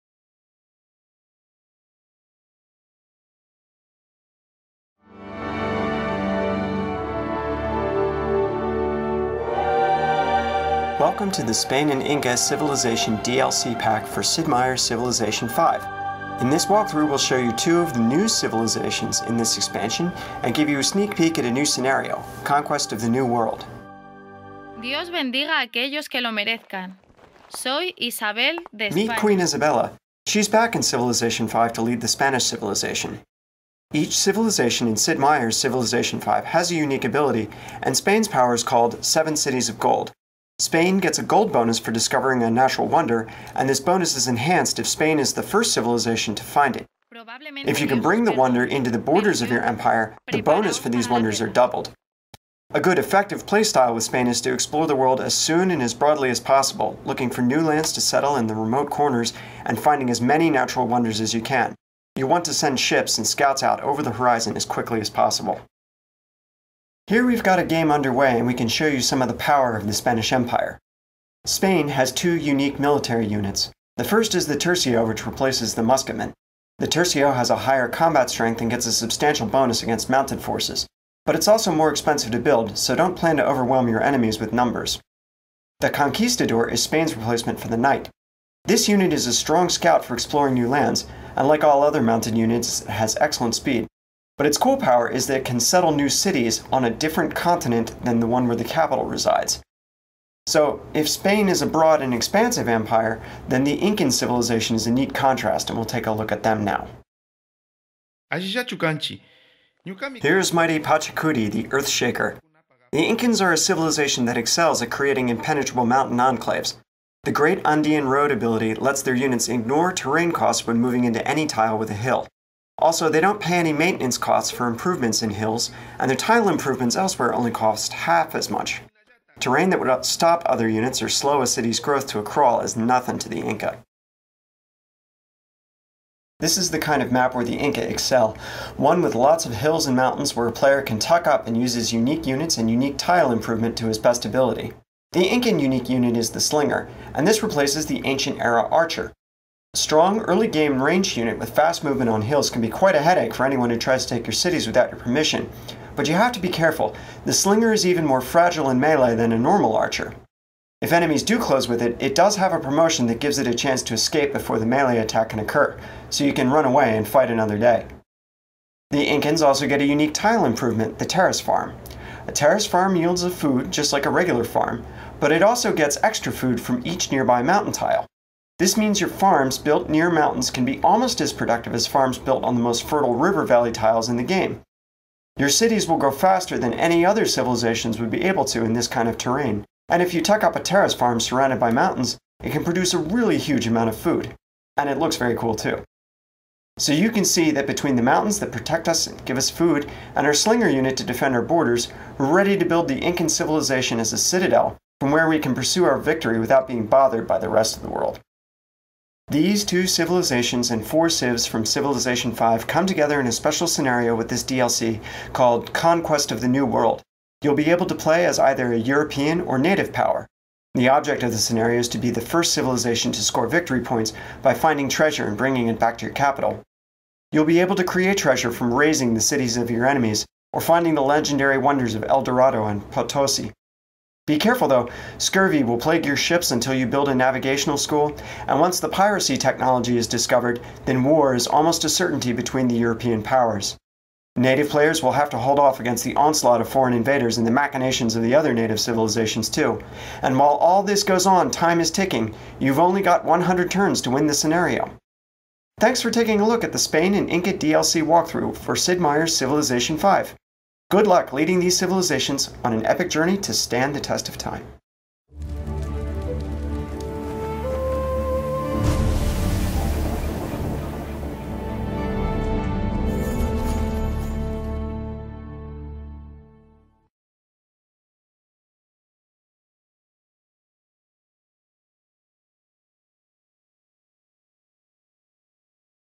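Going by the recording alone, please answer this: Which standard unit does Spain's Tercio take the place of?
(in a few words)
Musketmen.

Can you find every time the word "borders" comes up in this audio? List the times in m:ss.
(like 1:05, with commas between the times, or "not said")
0:48, 3:21.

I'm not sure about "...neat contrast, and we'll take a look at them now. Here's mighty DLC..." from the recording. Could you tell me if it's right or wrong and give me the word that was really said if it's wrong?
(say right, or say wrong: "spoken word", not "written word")
wrong: "Pachacuti", not "DLC".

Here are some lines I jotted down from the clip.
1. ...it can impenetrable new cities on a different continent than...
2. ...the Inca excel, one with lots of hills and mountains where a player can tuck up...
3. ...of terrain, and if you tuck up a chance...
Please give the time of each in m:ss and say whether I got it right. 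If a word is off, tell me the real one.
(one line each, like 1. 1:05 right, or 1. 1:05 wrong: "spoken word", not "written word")
1. 1:35 wrong: "settle", not "impenetrable"
2. 2:17 right
3. 3:09 wrong: "terrace", not "chance".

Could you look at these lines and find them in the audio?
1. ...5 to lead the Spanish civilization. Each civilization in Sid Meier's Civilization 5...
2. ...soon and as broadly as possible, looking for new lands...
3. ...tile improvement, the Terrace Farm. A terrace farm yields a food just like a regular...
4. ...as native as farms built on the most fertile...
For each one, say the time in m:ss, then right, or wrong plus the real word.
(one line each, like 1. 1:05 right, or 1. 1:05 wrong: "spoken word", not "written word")
1. 0:31 right
2. 0:55 right
3. 2:50 right
4. 3:01 wrong: "productive", not "native".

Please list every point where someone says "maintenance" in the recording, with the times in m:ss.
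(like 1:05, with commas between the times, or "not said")
2:03.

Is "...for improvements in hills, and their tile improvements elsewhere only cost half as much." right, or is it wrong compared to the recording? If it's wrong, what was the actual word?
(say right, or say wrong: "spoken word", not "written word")
right.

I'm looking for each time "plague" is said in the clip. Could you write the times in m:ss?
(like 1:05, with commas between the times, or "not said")
3:55.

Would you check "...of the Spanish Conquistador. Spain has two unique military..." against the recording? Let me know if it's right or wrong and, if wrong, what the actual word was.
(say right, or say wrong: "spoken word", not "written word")
wrong: "Empire", not "Conquistador".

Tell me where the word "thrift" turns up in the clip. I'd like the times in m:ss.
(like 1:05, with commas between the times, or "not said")
not said.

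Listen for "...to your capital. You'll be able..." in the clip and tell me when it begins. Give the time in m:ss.
3:45.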